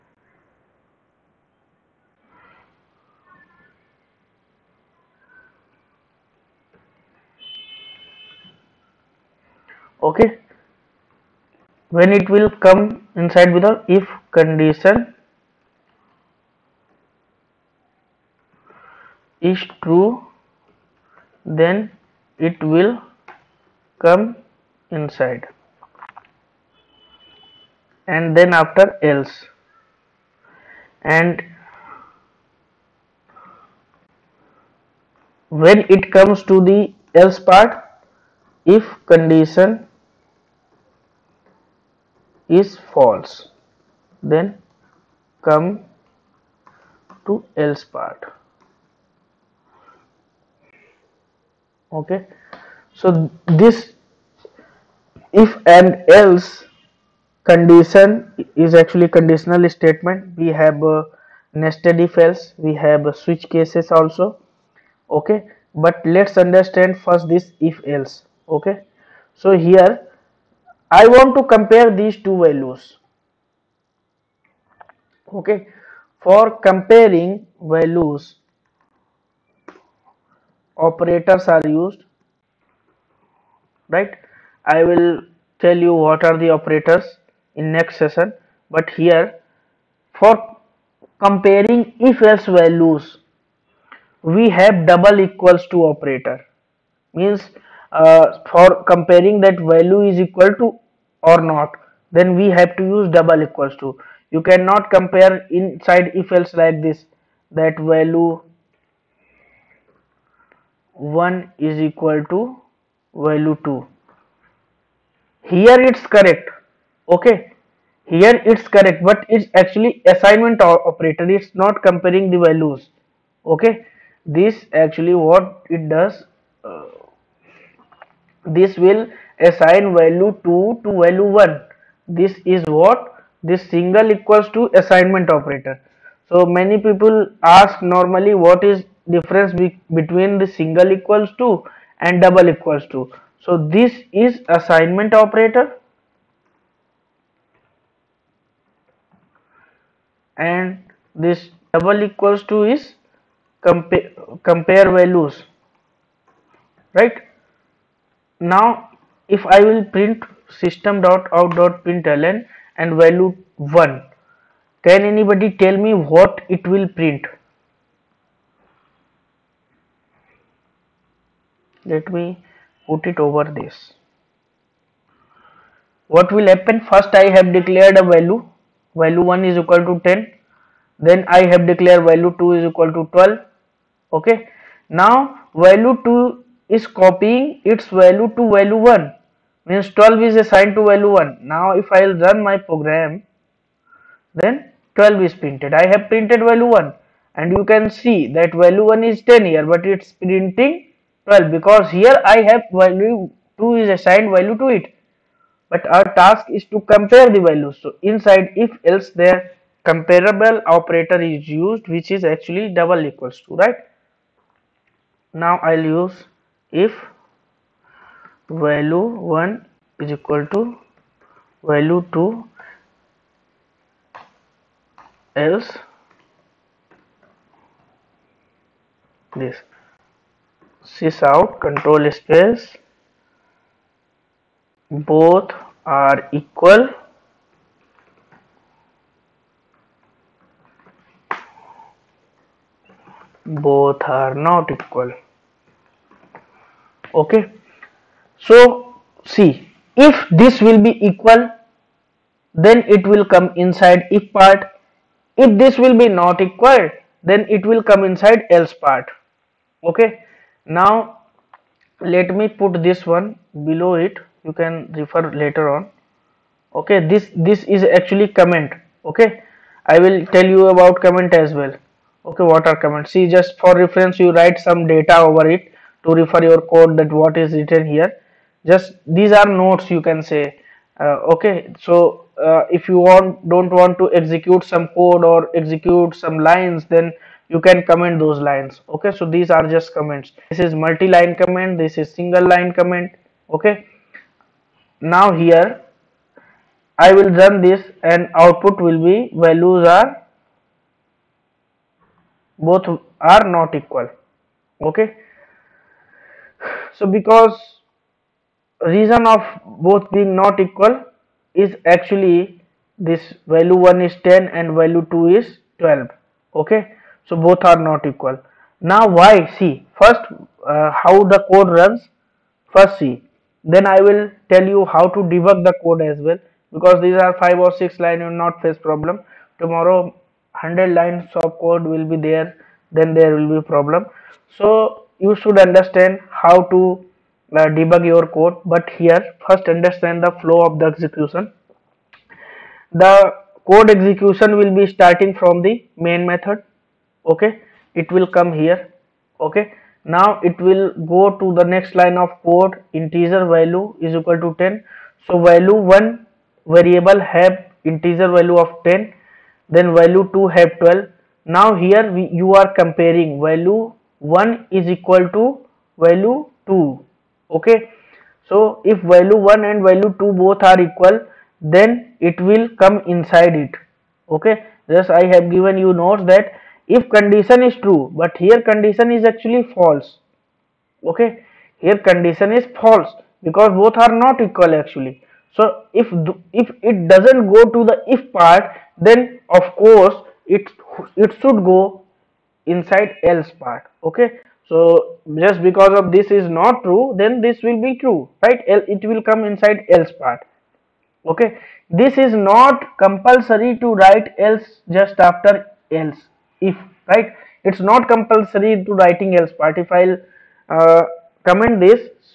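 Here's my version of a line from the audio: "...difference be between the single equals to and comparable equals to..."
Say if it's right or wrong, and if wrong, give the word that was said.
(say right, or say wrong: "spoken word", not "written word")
wrong: "double", not "comparable".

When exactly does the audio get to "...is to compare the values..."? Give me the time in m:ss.
3:26.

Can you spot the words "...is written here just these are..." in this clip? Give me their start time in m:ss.
4:37.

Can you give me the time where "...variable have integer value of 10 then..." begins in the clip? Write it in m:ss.
5:56.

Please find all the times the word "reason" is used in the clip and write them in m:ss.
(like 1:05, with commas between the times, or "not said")
5:08.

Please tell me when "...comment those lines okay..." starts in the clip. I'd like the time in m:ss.
4:47.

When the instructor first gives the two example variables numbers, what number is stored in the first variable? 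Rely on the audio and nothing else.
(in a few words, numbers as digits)
10.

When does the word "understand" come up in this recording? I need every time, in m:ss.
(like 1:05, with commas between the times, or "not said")
1:06, 5:35, 5:39.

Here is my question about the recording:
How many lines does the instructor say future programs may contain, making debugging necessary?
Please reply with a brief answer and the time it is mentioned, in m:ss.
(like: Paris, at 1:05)
100, at 5:30.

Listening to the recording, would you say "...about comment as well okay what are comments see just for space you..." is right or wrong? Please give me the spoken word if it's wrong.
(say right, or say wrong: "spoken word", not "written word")
wrong: "reference", not "space".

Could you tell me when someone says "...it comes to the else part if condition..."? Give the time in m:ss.
0:35.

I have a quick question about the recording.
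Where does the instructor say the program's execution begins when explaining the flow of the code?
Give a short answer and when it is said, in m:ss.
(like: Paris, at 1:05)
main method, at 5:45.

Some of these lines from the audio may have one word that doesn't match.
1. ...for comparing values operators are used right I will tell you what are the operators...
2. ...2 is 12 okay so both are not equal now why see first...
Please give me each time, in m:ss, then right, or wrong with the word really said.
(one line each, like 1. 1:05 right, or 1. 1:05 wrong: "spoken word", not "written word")
1. 1:16 right
2. 5:15 right.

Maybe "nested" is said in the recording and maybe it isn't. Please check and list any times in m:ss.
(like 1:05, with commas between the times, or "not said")
1:01.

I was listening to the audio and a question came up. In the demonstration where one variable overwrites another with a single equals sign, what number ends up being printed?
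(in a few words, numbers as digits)
12.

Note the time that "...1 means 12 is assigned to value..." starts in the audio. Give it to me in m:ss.
3:08.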